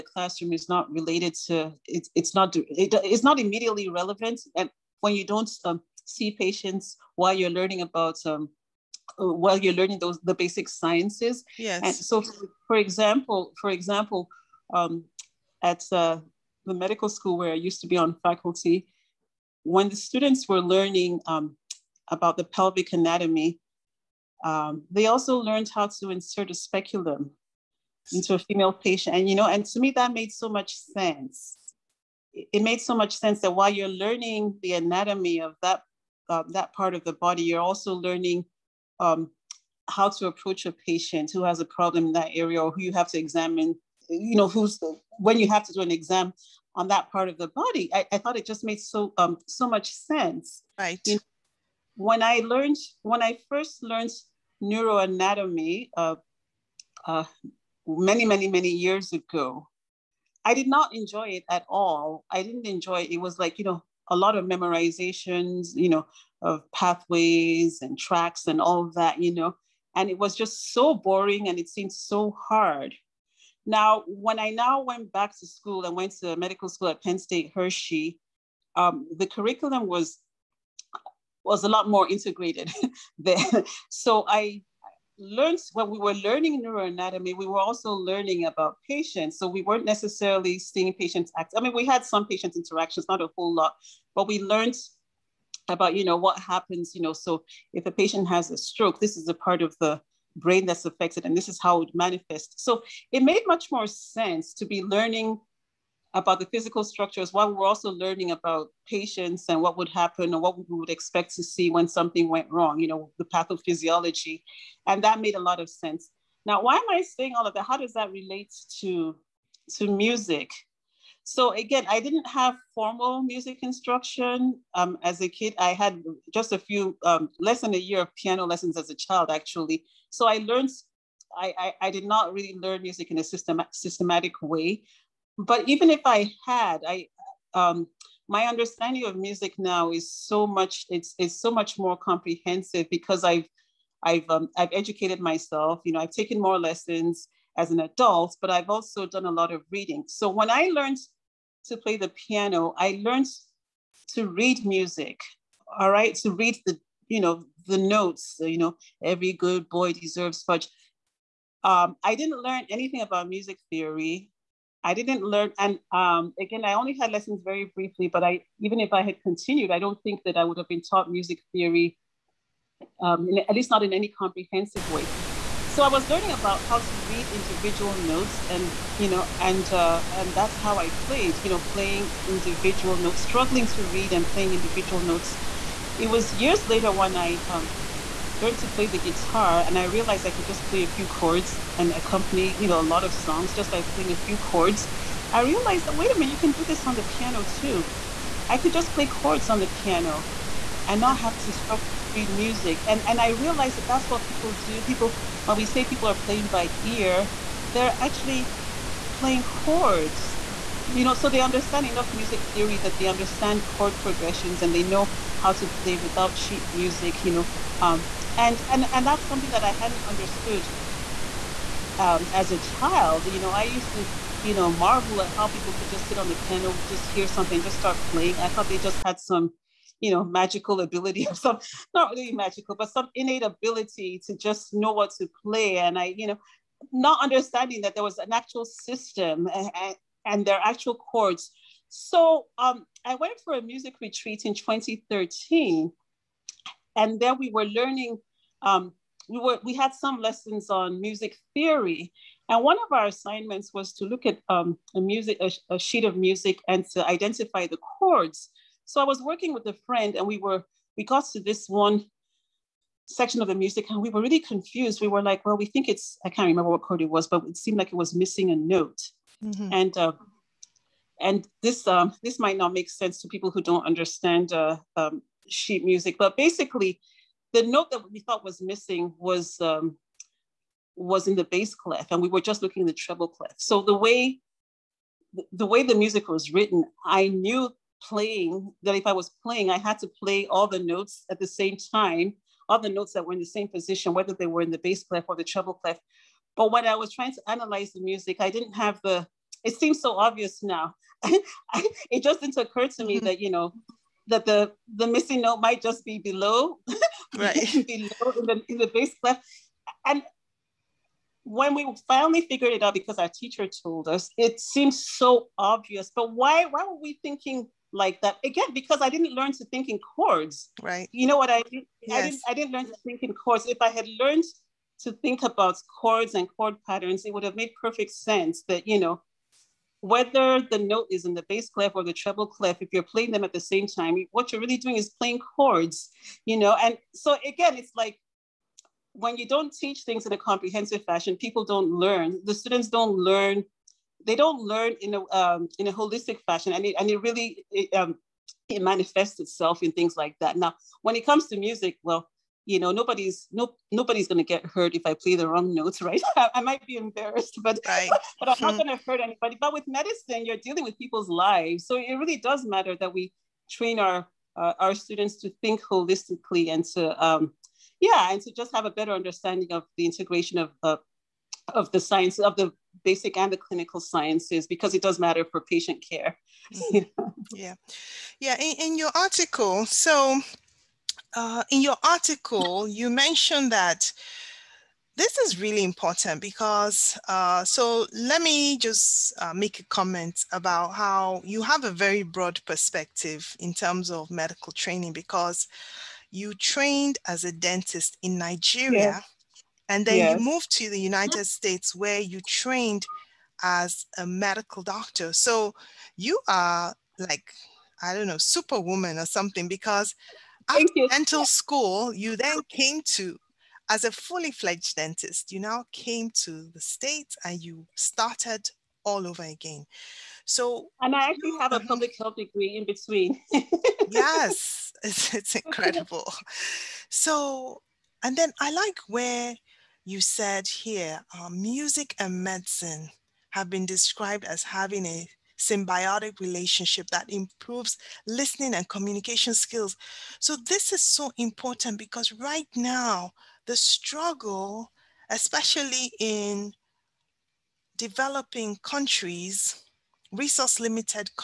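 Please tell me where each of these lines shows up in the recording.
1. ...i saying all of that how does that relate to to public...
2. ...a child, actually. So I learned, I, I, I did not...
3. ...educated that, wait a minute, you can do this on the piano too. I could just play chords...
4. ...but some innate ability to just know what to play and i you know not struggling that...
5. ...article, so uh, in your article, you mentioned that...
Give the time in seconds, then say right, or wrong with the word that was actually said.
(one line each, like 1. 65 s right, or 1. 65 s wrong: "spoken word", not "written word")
1. 116 s wrong: "music", not "public"
2. 128 s right
3. 195 s wrong: "realized", not "educated"
4. 232 s wrong: "understanding", not "struggling"
5. 379 s right.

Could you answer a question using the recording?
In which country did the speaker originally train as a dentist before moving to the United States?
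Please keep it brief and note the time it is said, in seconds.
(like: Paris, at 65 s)
Nigeria, at 398 s.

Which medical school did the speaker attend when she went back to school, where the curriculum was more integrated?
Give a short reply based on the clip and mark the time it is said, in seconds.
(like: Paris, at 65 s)
Penn State Hershey, at 77 s.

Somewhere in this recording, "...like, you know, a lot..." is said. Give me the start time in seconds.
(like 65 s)
63 s.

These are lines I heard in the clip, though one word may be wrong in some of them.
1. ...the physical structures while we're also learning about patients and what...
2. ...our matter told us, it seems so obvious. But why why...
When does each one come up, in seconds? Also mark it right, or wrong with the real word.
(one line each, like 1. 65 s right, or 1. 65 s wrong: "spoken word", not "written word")
1. 106 s right
2. 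313 s wrong: "teacher", not "matter".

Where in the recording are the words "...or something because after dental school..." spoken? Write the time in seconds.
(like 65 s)
409 s.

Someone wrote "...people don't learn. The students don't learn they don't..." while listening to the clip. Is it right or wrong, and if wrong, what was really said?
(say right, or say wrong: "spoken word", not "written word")
right.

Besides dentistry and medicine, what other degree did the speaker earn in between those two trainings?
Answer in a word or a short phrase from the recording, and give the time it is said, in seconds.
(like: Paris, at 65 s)
Public health, at 421 s.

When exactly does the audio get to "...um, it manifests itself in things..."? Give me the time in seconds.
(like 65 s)
347 s.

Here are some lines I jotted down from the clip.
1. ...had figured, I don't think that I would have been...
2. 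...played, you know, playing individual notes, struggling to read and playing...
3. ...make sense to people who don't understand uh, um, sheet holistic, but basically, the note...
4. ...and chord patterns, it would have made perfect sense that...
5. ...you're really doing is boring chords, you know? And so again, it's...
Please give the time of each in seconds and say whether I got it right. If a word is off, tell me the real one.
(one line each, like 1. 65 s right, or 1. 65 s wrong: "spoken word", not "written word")
1. 169 s wrong: "continued", not "figured"
2. 181 s right
3. 272 s wrong: "music", not "holistic"
4. 326 s right
5. 334 s wrong: "playing", not "boring".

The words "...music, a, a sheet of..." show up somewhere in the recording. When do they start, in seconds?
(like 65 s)
254 s.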